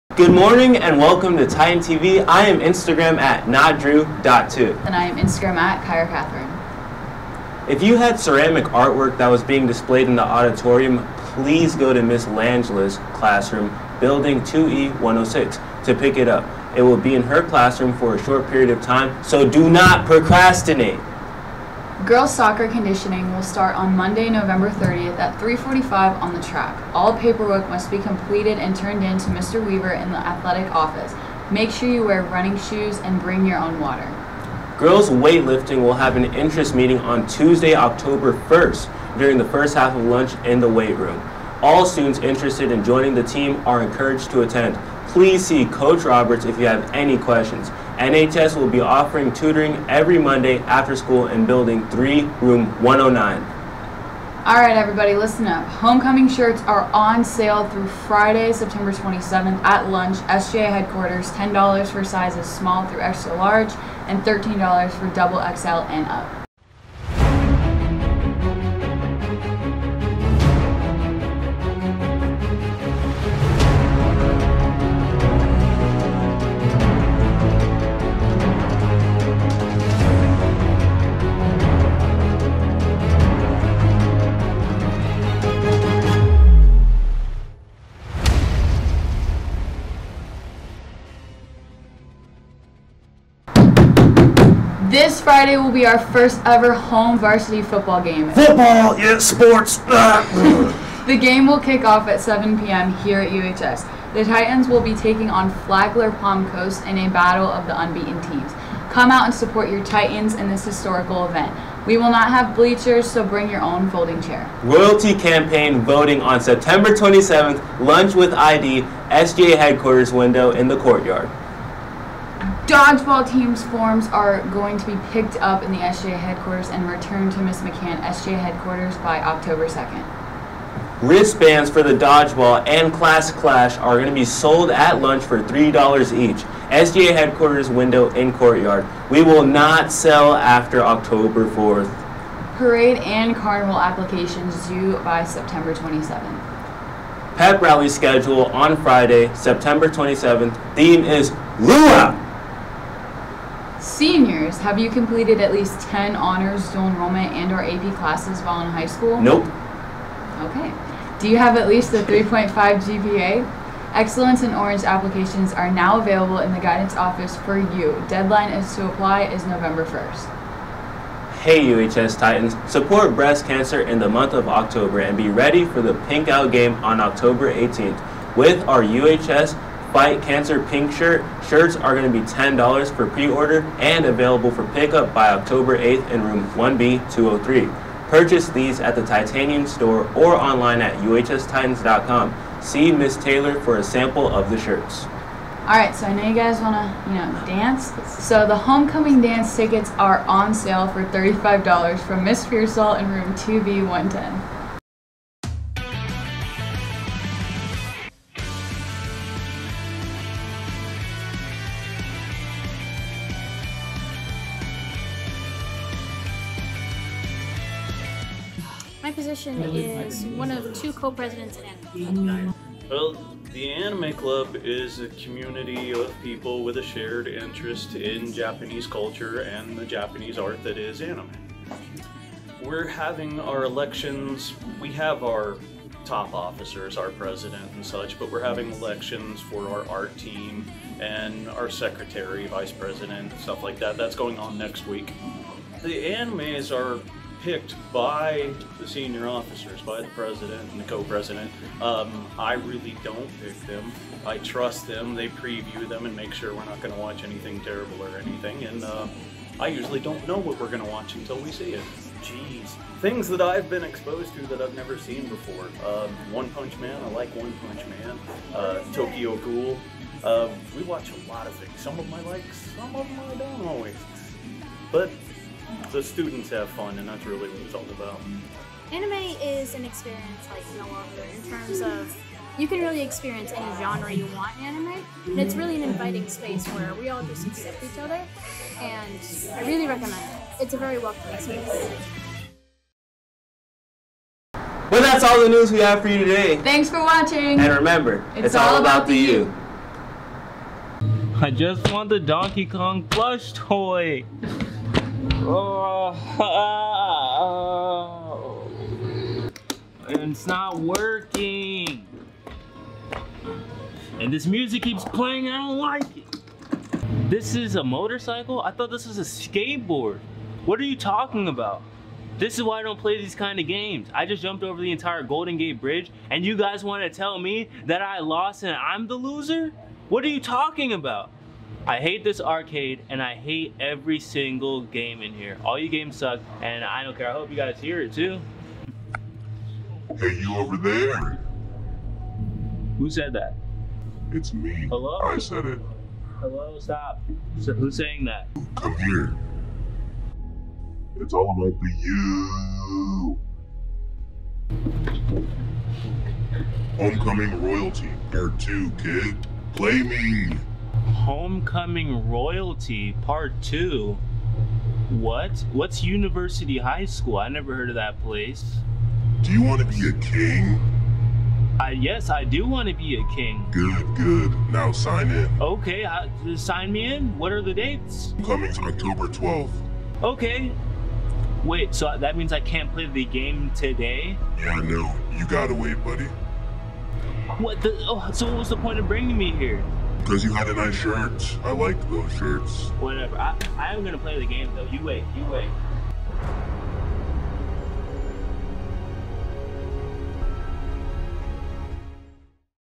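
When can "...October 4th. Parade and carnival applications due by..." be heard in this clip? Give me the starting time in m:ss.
2:20.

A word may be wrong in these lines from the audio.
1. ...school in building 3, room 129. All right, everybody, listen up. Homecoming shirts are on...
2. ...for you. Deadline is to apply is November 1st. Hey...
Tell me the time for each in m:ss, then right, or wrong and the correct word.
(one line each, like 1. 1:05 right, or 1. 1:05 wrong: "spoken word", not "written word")
1. 0:50 wrong: "109", not "129"
2. 2:47 right.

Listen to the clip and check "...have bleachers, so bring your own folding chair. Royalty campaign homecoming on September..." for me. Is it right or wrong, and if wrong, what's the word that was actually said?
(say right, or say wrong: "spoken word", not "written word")
wrong: "voting", not "homecoming".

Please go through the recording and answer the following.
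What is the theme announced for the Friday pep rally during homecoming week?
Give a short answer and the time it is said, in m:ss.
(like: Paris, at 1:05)
Luau, at 2:31.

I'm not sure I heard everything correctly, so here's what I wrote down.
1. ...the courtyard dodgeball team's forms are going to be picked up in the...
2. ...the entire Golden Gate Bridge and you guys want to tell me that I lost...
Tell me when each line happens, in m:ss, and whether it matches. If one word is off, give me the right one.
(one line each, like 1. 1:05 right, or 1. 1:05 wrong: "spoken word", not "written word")
1. 2:00 right
2. 5:24 right.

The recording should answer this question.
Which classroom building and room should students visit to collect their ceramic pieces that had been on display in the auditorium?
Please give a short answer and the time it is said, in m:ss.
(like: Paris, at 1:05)
2E106, at 0:13.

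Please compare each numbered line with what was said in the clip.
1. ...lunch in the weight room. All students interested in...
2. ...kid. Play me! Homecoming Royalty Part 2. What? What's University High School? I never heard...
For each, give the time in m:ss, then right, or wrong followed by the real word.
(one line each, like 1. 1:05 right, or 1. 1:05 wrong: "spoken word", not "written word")
1. 0:40 right
2. 5:59 right.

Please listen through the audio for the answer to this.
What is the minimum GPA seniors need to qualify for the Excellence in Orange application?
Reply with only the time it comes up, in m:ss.
2:42.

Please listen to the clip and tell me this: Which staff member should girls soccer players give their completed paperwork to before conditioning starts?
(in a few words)
Mr. Weaver.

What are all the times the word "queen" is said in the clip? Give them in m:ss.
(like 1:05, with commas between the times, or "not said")
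not said.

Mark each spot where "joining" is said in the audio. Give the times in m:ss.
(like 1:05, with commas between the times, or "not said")
0:42.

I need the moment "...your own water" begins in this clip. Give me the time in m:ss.
0:33.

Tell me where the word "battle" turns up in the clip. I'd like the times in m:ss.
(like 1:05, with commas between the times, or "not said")
1:47.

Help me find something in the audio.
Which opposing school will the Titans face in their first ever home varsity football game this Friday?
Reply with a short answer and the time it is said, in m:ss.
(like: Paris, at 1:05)
Flagler Palm Coast, at 1:45.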